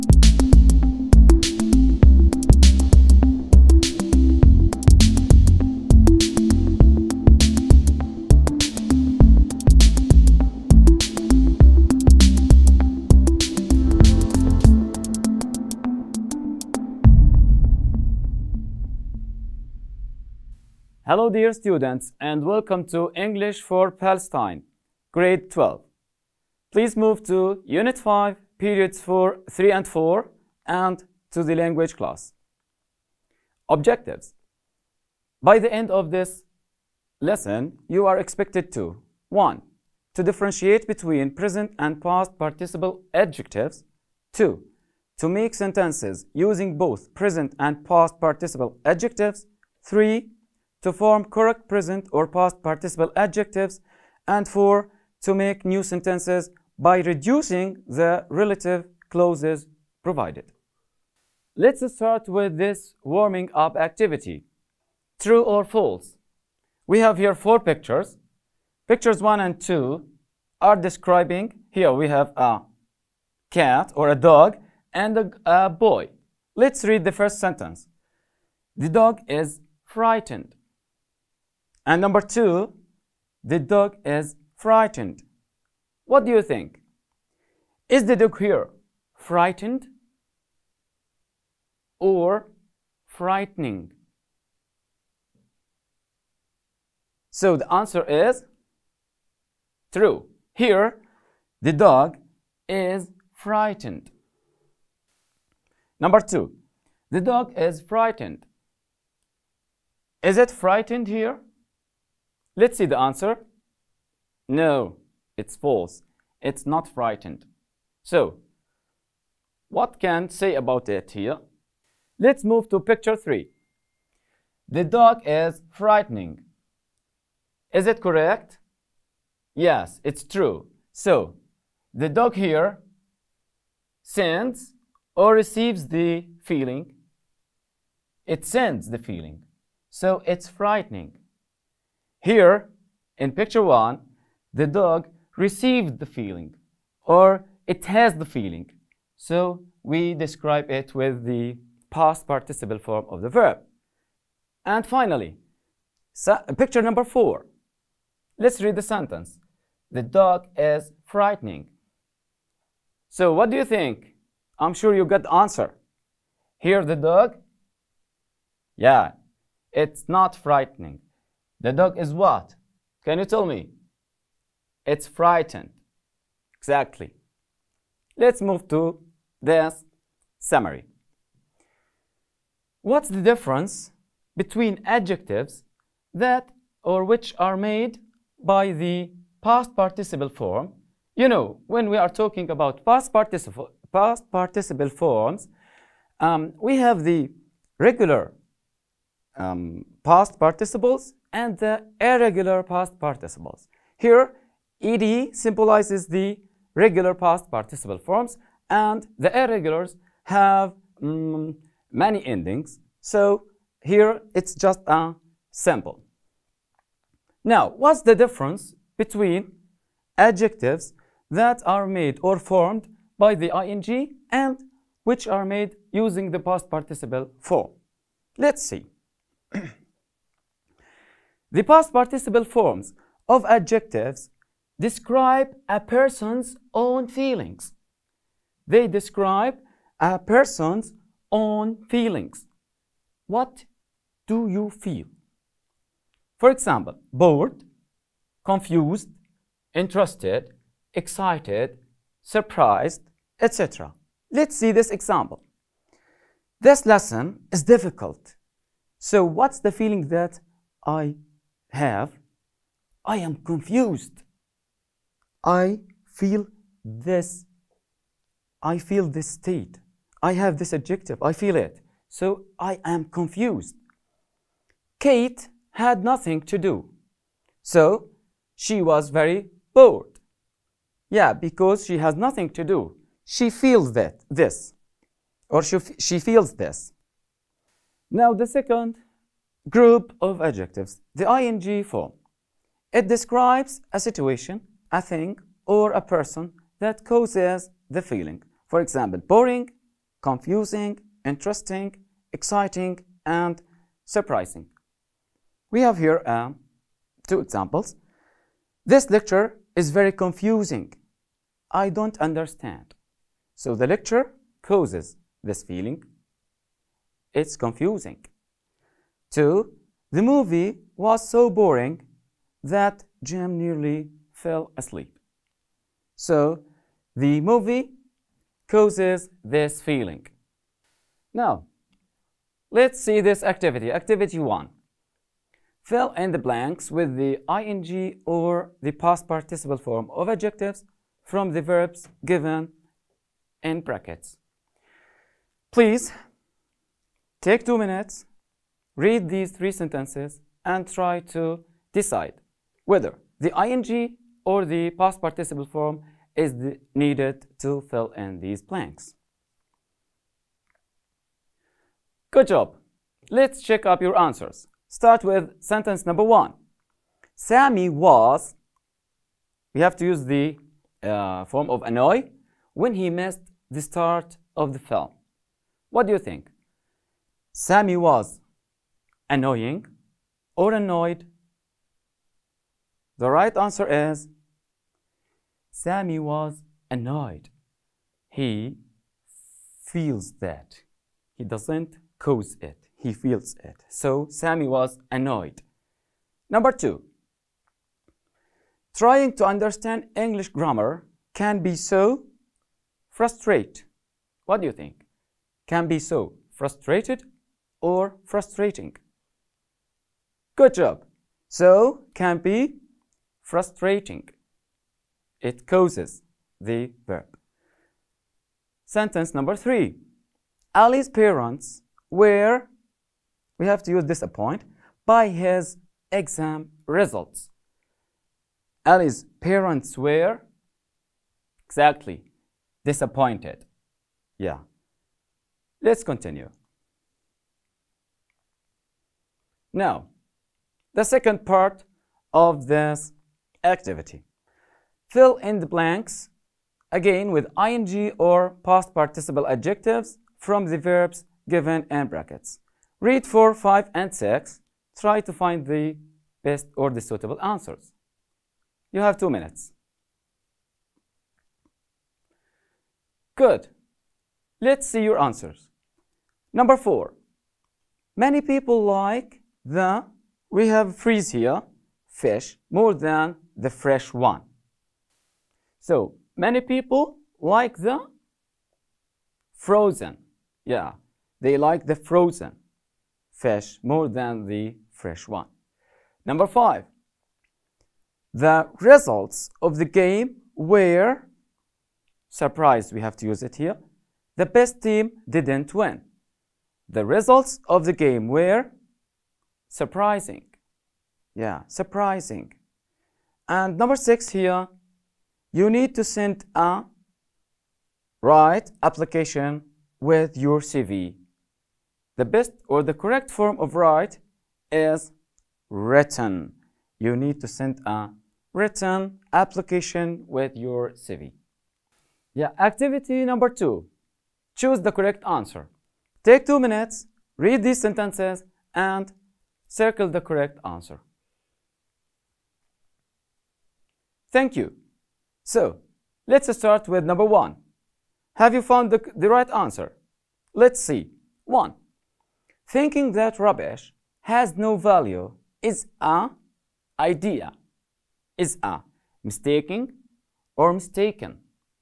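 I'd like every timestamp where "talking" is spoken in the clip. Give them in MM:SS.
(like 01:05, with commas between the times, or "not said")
03:12.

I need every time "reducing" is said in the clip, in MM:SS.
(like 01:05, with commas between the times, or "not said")
00:56.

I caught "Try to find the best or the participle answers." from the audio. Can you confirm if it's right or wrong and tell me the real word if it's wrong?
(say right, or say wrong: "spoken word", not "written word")
wrong: "suitable", not "participle".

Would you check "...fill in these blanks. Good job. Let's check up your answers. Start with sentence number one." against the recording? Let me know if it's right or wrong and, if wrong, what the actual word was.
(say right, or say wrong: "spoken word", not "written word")
right.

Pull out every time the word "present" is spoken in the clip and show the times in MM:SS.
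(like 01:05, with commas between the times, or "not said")
00:41, 00:47, 00:51.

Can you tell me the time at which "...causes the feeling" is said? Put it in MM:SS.
04:57.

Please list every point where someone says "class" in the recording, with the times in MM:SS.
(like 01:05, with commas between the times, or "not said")
00:31.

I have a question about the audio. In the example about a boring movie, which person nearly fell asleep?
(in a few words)
Jim.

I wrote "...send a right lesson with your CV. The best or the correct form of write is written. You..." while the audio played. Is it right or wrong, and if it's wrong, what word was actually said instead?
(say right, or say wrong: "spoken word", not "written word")
wrong: "application", not "lesson".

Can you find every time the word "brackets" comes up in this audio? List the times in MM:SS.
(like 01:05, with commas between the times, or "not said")
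05:43, 07:32.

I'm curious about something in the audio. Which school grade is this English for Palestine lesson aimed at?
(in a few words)
Grade 12.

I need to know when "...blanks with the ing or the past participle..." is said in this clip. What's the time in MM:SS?
05:36.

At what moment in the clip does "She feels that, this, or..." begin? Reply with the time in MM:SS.
04:43.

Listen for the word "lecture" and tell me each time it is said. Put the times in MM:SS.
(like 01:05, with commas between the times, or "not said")
05:09, 05:13.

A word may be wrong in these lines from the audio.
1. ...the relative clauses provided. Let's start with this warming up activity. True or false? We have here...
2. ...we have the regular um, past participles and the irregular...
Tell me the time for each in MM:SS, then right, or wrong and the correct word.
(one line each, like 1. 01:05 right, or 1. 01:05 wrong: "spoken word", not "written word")
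1. 00:57 right
2. 03:16 right.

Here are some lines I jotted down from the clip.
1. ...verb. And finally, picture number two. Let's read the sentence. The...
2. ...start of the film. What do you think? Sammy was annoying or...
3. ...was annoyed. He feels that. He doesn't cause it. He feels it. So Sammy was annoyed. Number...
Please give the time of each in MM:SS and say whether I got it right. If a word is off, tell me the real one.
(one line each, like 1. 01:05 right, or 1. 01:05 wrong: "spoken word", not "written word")
1. 02:33 wrong: "four", not "two"
2. 06:13 right
3. 06:26 right.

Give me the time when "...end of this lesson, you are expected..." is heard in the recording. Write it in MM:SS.
00:35.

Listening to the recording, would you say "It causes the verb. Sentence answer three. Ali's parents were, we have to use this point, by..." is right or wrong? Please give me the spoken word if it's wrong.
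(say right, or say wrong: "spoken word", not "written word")
wrong: "number", not "answer".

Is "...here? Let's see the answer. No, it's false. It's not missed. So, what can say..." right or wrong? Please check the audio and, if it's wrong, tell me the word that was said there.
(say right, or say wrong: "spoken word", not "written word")
wrong: "frightened", not "missed".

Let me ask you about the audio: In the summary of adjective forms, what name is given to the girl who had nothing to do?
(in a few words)
Kate.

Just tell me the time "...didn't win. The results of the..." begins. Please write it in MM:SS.
08:15.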